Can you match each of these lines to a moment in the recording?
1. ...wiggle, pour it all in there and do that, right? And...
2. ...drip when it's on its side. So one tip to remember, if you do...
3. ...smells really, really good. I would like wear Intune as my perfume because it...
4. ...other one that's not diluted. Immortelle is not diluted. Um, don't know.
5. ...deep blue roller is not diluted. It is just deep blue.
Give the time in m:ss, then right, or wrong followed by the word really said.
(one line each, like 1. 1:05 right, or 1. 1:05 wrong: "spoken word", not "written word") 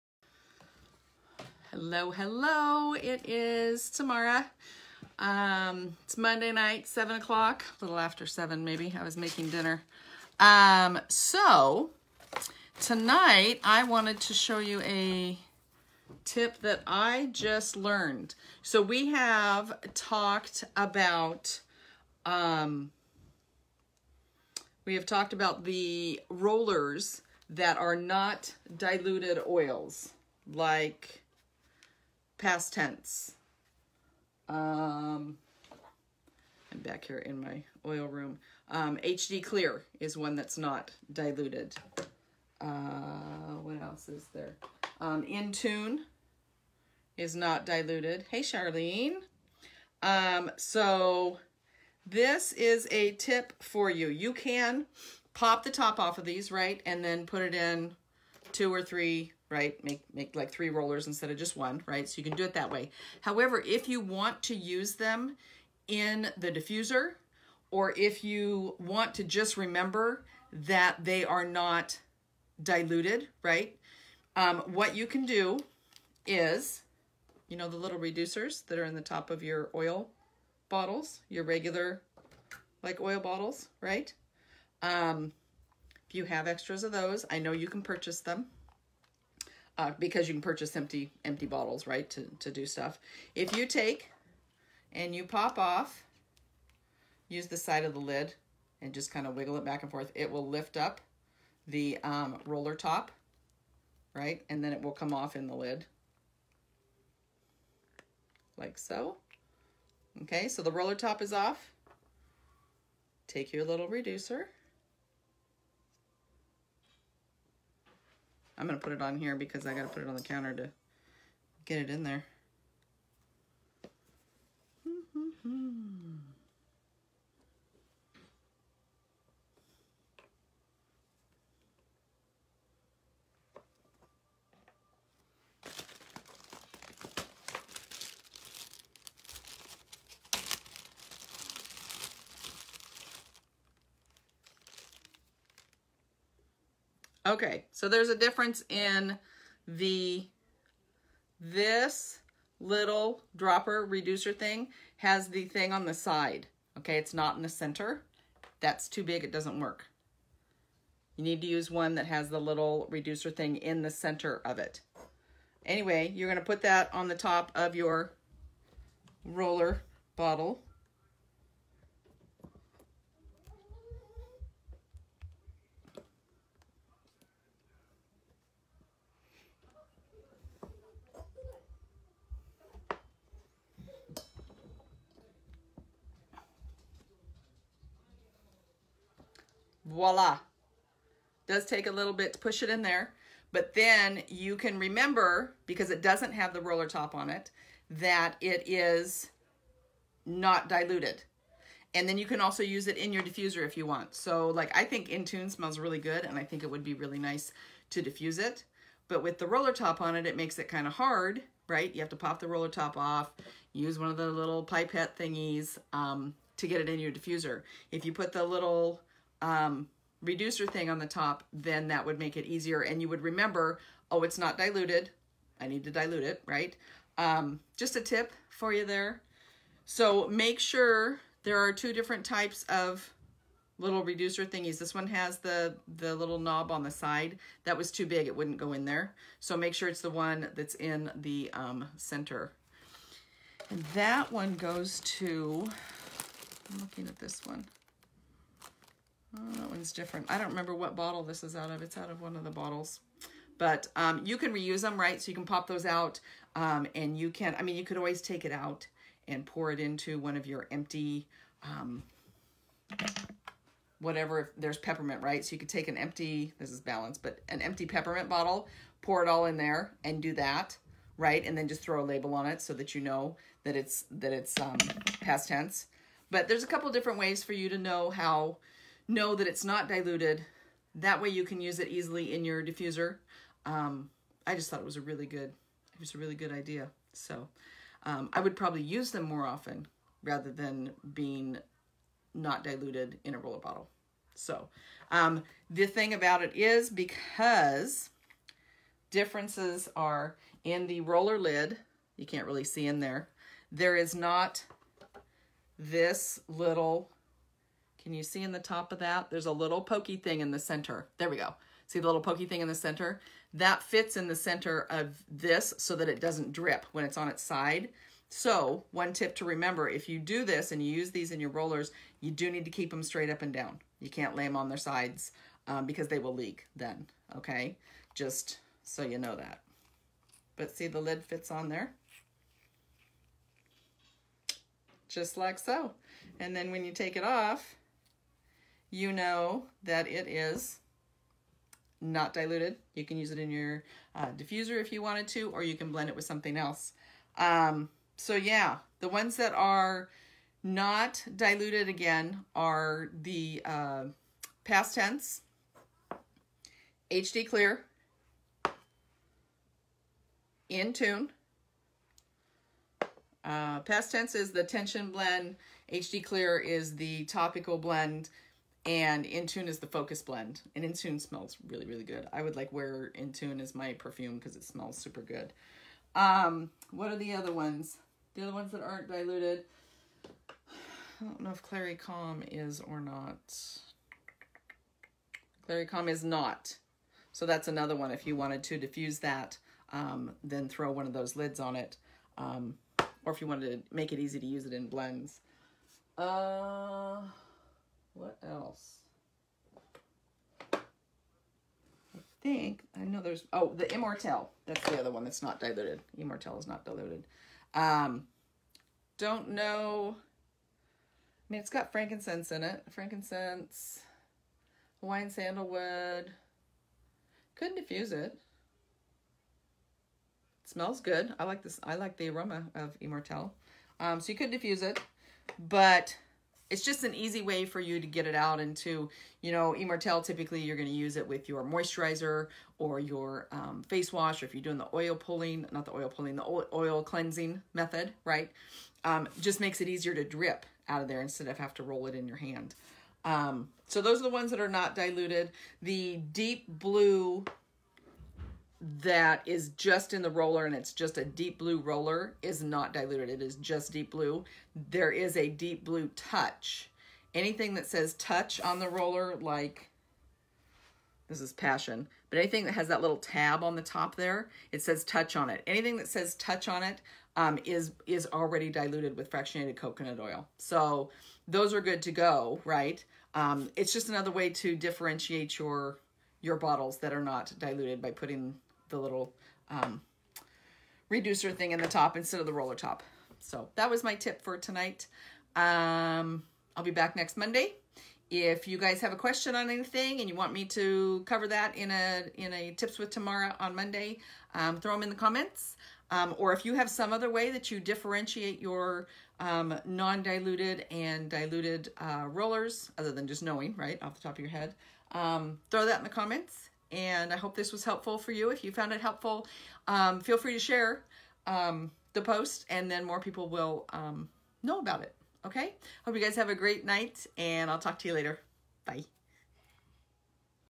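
1. 4:28 wrong: "bottle", not "wiggle"
2. 5:16 right
3. 6:11 right
4. 6:44 right
5. 7:31 right.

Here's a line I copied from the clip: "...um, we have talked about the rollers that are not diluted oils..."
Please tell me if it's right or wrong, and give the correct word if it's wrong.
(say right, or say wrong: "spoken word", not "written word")
right.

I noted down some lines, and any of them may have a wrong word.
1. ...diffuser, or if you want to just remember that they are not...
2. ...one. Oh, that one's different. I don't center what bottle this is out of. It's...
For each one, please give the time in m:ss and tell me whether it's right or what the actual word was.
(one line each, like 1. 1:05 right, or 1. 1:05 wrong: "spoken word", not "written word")
1. 1:06 right
2. 4:07 wrong: "remember", not "center".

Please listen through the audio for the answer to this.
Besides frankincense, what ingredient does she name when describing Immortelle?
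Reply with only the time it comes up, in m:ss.
6:55.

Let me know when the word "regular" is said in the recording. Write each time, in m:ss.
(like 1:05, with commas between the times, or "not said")
1:21.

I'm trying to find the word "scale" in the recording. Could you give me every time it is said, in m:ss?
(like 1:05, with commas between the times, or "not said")
not said.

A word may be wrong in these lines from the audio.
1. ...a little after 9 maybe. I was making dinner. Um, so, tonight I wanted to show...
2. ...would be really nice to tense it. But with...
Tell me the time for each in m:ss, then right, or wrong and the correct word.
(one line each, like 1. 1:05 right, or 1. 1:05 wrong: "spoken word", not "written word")
1. 0:07 wrong: "7", not "9"
2. 3:26 wrong: "diffuse", not "tense".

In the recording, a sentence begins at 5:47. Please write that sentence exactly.
Um, so yeah, the ones that are not diluted again are the uh, past tense, HD clear, in tune.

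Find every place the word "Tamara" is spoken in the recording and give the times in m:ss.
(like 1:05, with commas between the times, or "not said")
0:03, 8:13.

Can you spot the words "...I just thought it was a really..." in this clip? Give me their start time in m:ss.
4:44.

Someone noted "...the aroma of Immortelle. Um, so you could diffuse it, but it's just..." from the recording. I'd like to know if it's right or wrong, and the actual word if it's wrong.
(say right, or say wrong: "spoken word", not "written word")
right.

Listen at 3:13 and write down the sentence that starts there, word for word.
But then you can remember, because it doesn't have the roller top on it, that it is not diluted.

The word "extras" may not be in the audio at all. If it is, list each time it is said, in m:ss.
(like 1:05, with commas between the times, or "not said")
1:26.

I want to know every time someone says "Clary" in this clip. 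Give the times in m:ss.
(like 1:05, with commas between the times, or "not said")
6:21, 6:25.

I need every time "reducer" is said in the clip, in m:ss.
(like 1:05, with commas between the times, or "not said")
1:17, 1:53, 2:33, 2:42, 3:40, 3:54, 8:01.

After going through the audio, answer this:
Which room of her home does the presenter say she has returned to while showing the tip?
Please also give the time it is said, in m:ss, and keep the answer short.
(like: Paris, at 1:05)
oil room, at 0:37.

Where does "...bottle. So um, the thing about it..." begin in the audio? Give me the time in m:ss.
4:53.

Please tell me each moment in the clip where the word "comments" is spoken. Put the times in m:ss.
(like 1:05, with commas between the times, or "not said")
8:15, 8:26.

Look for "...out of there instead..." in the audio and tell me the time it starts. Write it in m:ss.
7:20.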